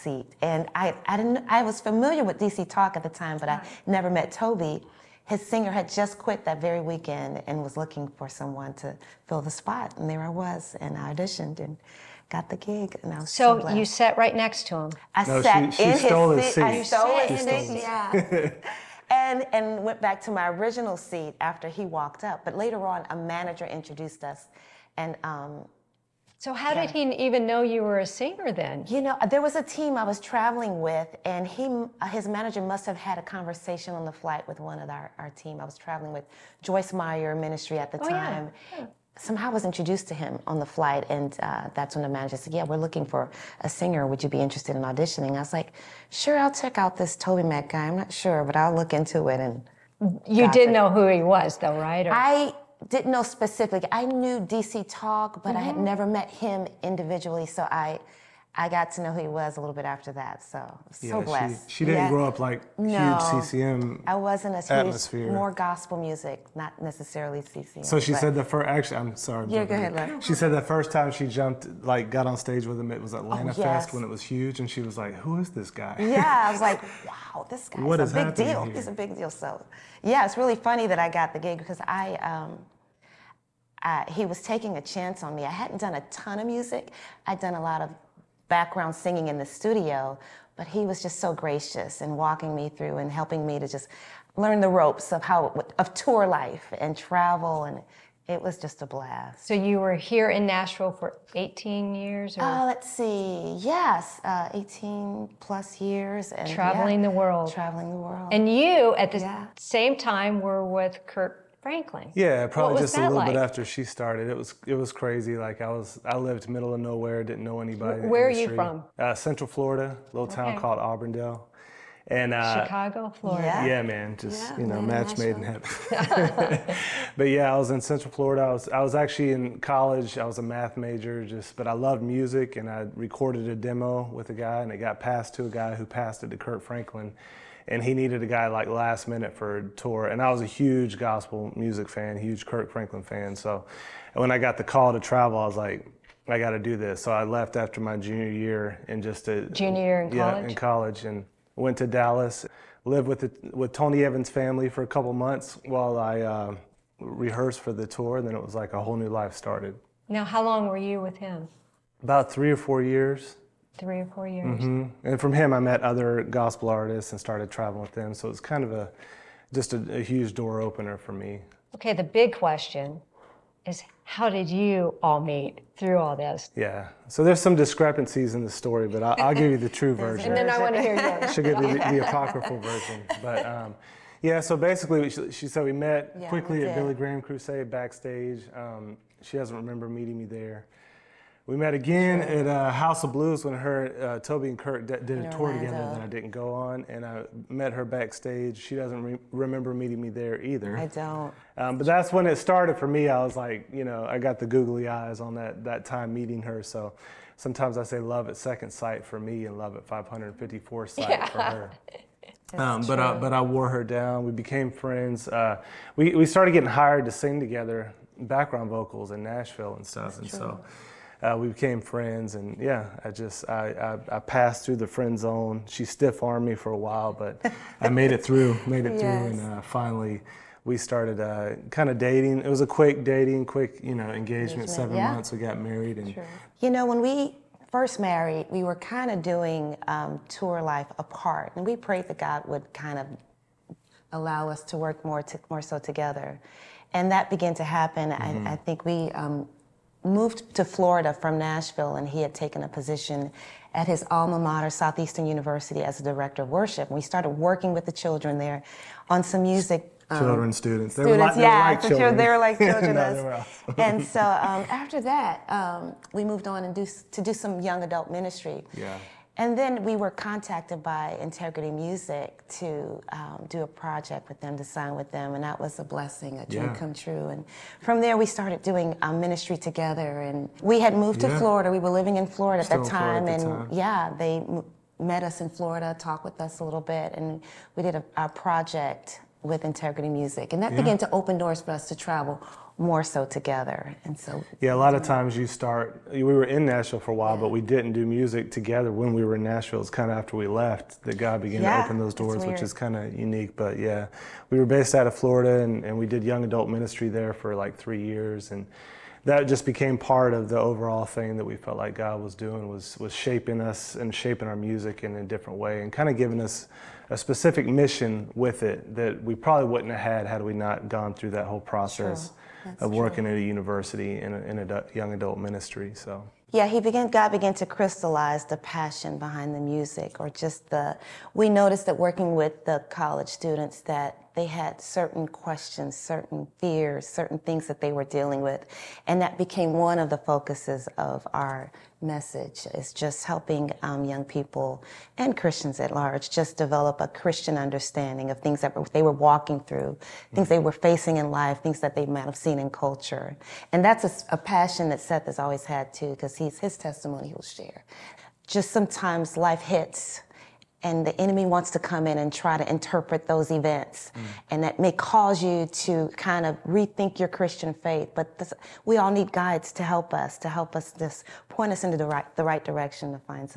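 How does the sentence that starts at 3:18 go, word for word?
She doesn't re- remember meeting me there either.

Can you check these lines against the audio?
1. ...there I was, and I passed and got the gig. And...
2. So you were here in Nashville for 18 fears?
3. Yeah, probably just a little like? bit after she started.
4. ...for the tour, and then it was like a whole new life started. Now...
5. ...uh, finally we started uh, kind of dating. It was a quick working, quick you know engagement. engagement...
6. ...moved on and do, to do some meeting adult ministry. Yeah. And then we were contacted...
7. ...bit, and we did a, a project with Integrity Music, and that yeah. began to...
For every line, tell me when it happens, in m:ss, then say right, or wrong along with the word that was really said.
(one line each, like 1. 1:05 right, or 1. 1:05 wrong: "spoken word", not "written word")
1. 0:10 wrong: "auditioned", not "passed"
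2. 1:39 wrong: "years", not "fears"
3. 1:52 right
4. 2:37 right
5. 3:49 wrong: "dating", not "working"
6. 4:26 wrong: "young", not "meeting"
7. 4:46 right.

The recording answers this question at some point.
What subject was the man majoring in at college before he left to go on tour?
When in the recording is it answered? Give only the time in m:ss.
2:10.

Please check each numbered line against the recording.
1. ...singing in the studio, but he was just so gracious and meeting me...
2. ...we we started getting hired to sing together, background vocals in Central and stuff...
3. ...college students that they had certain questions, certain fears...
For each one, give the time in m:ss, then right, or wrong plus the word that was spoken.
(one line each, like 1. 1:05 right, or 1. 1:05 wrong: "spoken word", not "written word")
1. 1:28 wrong: "walking", not "meeting"
2. 3:35 wrong: "Nashville", not "Central"
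3. 5:32 right.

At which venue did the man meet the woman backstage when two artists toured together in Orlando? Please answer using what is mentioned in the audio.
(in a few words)
House of Blues.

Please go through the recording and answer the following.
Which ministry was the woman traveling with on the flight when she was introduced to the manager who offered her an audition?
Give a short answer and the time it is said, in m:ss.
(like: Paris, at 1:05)
Joyce Meyer Ministry, at 0:36.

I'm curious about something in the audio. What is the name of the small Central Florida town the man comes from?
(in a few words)
Auburndale.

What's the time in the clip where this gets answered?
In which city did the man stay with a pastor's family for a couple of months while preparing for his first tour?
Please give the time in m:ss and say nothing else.
2:31.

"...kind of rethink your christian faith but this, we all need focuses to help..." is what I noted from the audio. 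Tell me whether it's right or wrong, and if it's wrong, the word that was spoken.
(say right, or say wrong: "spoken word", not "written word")
wrong: "guides", not "focuses".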